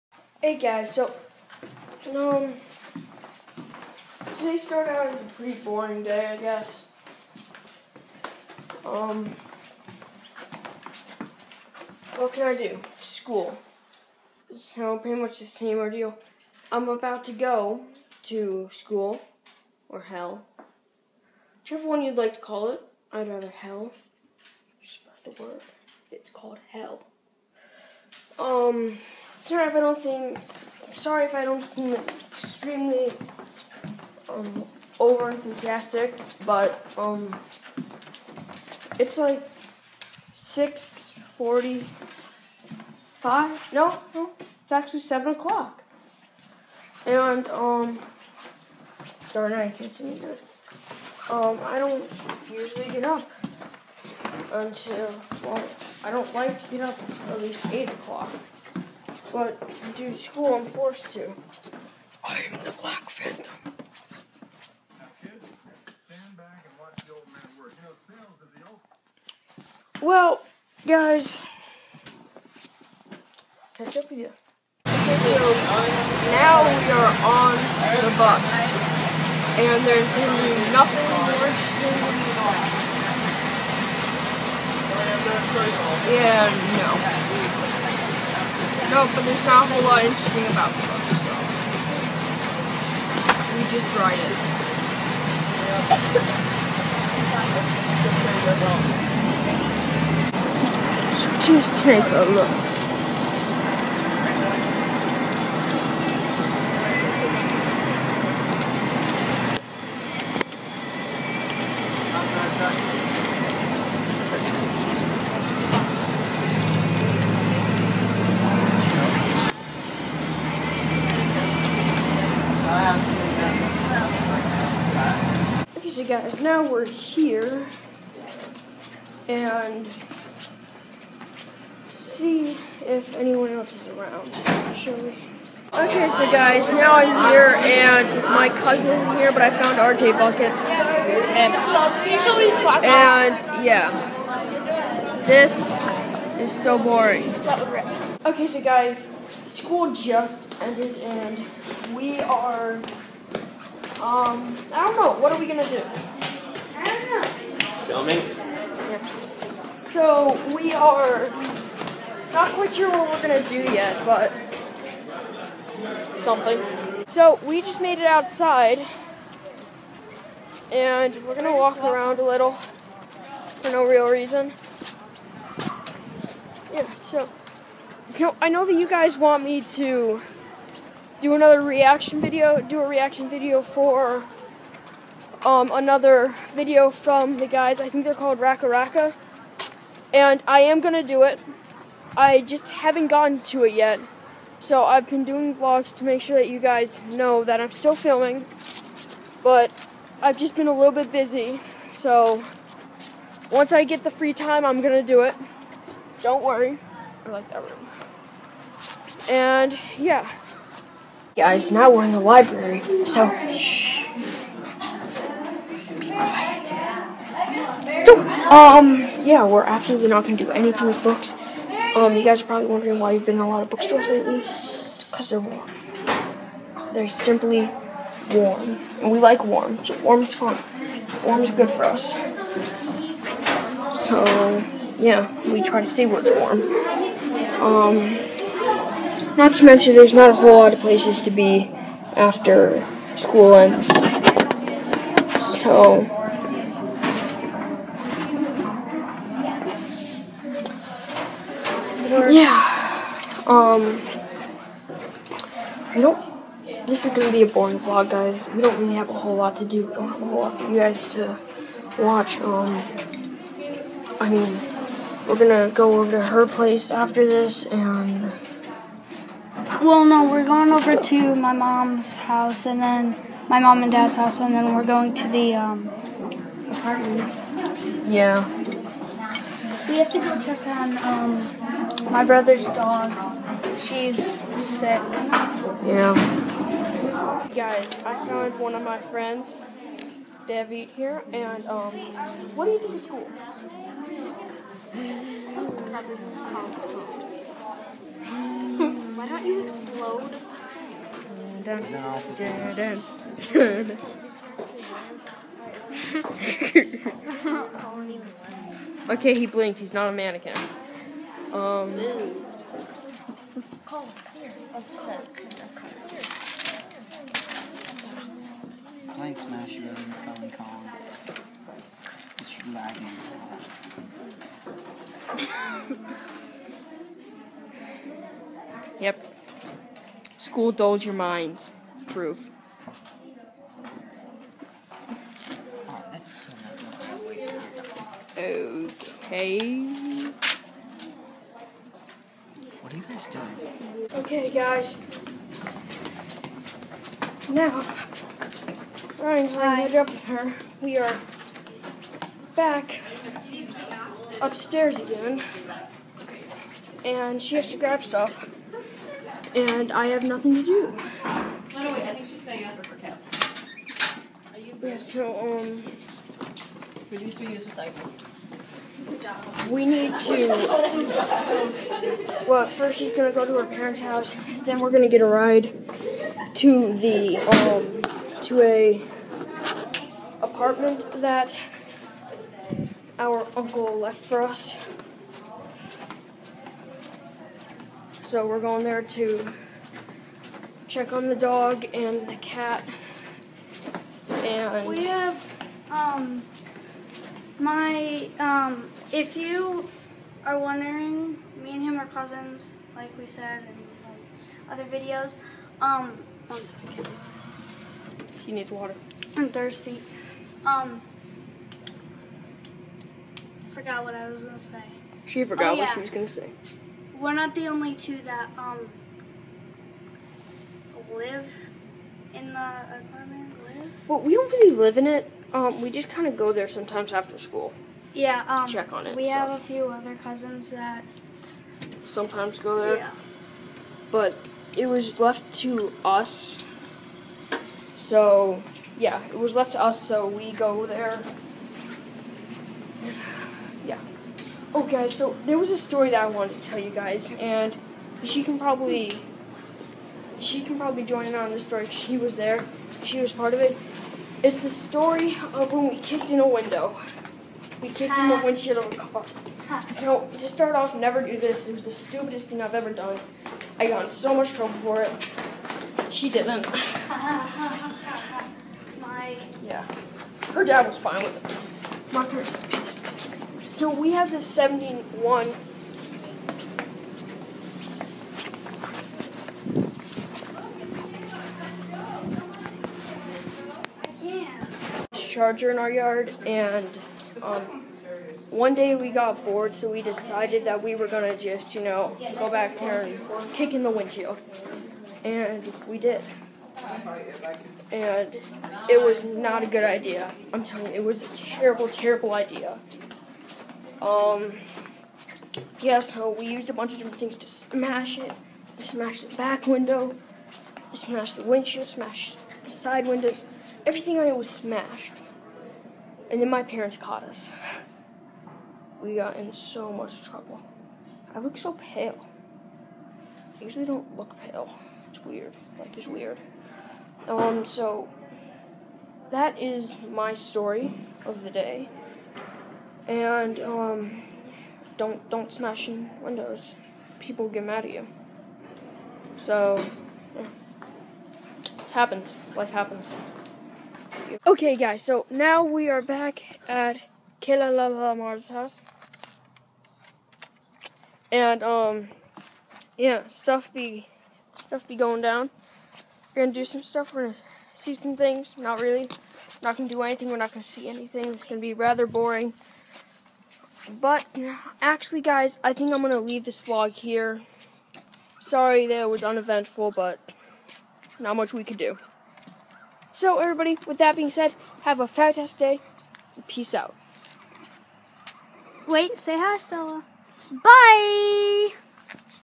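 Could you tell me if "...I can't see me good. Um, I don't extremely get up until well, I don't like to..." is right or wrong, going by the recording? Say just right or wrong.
wrong.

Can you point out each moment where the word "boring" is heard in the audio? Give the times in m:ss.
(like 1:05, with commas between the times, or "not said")
0:05, 2:26, 4:17, 9:22.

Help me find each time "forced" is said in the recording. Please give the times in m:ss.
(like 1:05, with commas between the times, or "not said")
1:00.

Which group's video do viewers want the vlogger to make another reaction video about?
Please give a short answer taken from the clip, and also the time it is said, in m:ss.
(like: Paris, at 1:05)
Raka Raka, at 3:08.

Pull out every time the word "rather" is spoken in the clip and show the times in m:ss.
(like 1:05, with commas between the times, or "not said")
0:23, 9:21.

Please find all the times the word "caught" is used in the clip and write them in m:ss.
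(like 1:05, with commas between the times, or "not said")
8:36.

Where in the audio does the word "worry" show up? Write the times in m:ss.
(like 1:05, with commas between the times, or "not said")
3:26.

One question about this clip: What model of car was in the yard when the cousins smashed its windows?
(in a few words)
71 Charger.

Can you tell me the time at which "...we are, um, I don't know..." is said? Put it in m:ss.
2:31.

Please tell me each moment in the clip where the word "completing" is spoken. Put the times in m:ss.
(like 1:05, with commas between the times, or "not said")
not said.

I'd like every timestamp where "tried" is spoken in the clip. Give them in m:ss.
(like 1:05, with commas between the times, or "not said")
1:33.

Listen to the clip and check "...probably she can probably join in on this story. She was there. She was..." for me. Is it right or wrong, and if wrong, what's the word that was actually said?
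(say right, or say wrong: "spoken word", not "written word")
right.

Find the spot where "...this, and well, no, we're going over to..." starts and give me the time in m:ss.
4:27.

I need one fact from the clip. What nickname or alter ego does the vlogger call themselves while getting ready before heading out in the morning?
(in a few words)
The Black Phantom.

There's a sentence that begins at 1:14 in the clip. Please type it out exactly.
Okay, so now we are on the bus, and there's gonna be nothing worse than yeah, no.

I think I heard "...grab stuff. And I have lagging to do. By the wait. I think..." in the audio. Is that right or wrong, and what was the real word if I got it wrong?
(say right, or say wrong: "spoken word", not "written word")
wrong: "nothing", not "lagging".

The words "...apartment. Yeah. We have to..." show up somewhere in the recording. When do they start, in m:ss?
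4:36.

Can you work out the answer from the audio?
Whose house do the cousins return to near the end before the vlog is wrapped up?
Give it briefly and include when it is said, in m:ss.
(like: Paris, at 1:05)
Lamar's house, at 9:07.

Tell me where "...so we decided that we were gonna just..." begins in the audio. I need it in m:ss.
8:09.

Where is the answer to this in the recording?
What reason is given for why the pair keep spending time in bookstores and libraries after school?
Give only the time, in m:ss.
3:45.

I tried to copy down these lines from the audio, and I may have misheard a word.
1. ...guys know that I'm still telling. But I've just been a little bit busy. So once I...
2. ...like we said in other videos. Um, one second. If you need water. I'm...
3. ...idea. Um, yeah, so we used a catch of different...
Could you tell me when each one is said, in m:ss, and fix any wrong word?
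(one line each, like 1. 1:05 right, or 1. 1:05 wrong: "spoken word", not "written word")
1. 3:16 wrong: "filming", not "telling"
2. 6:42 right
3. 8:22 wrong: "bunch", not "catch".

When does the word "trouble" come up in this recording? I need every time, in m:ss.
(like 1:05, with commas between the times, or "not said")
7:44, 8:40.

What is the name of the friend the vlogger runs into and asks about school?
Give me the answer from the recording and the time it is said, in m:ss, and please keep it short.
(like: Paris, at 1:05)
David, at 4:50.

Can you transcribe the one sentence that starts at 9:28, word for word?
Sorry that it was uneventful, but not much we could do.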